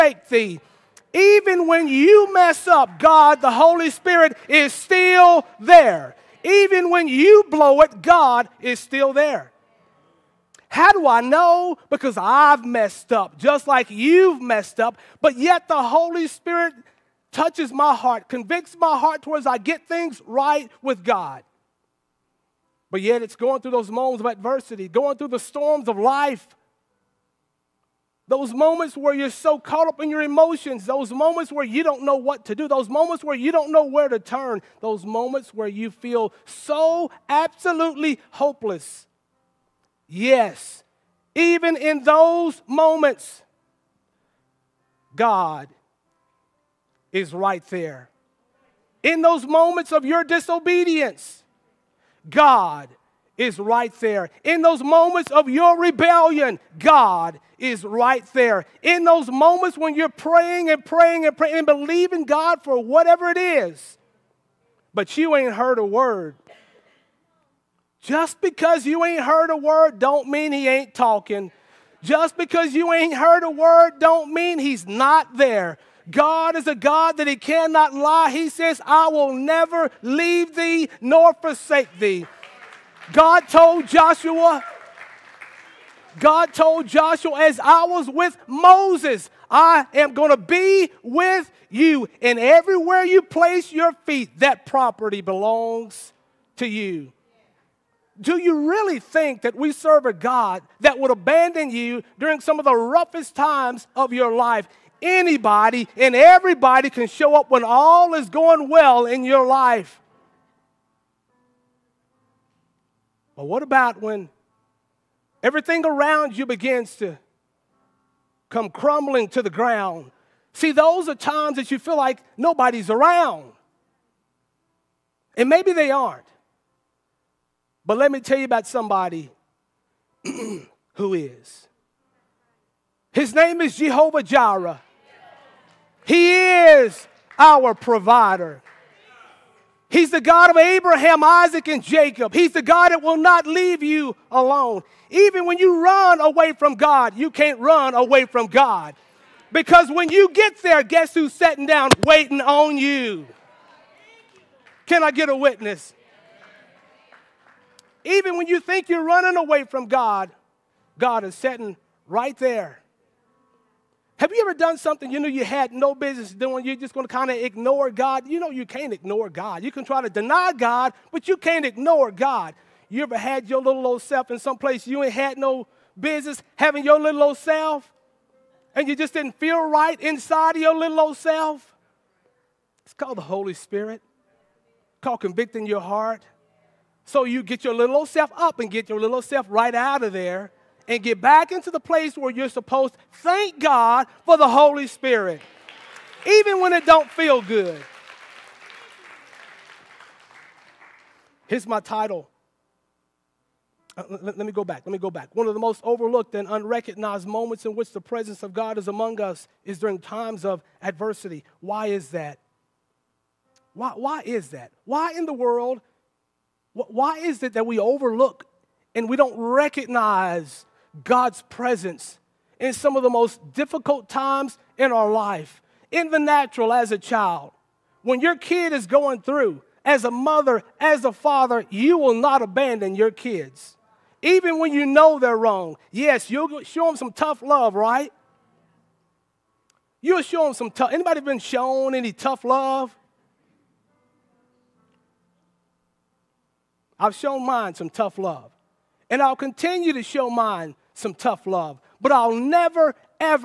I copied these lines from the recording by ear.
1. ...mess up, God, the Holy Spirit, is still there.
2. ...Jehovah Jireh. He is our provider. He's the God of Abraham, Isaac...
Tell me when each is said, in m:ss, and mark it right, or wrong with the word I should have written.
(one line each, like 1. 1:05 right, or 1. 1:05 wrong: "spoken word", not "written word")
1. 0:02 right
2. 2:13 right.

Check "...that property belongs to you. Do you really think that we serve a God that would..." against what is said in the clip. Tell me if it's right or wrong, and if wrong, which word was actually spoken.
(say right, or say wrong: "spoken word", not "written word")
right.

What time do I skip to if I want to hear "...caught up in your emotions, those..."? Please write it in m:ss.
0:29.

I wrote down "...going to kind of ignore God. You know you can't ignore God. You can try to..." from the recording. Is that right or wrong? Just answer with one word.
right.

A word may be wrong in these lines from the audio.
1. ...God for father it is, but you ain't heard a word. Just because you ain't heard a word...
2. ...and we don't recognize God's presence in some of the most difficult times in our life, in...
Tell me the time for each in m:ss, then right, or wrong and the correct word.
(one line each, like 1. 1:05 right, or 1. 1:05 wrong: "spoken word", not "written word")
1. 1:02 wrong: "whatever", not "father"
2. 3:38 right.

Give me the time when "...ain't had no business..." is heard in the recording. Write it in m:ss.
2:55.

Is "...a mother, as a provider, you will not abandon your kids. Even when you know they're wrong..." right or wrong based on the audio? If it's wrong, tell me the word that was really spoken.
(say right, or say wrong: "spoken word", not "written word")
wrong: "father", not "provider".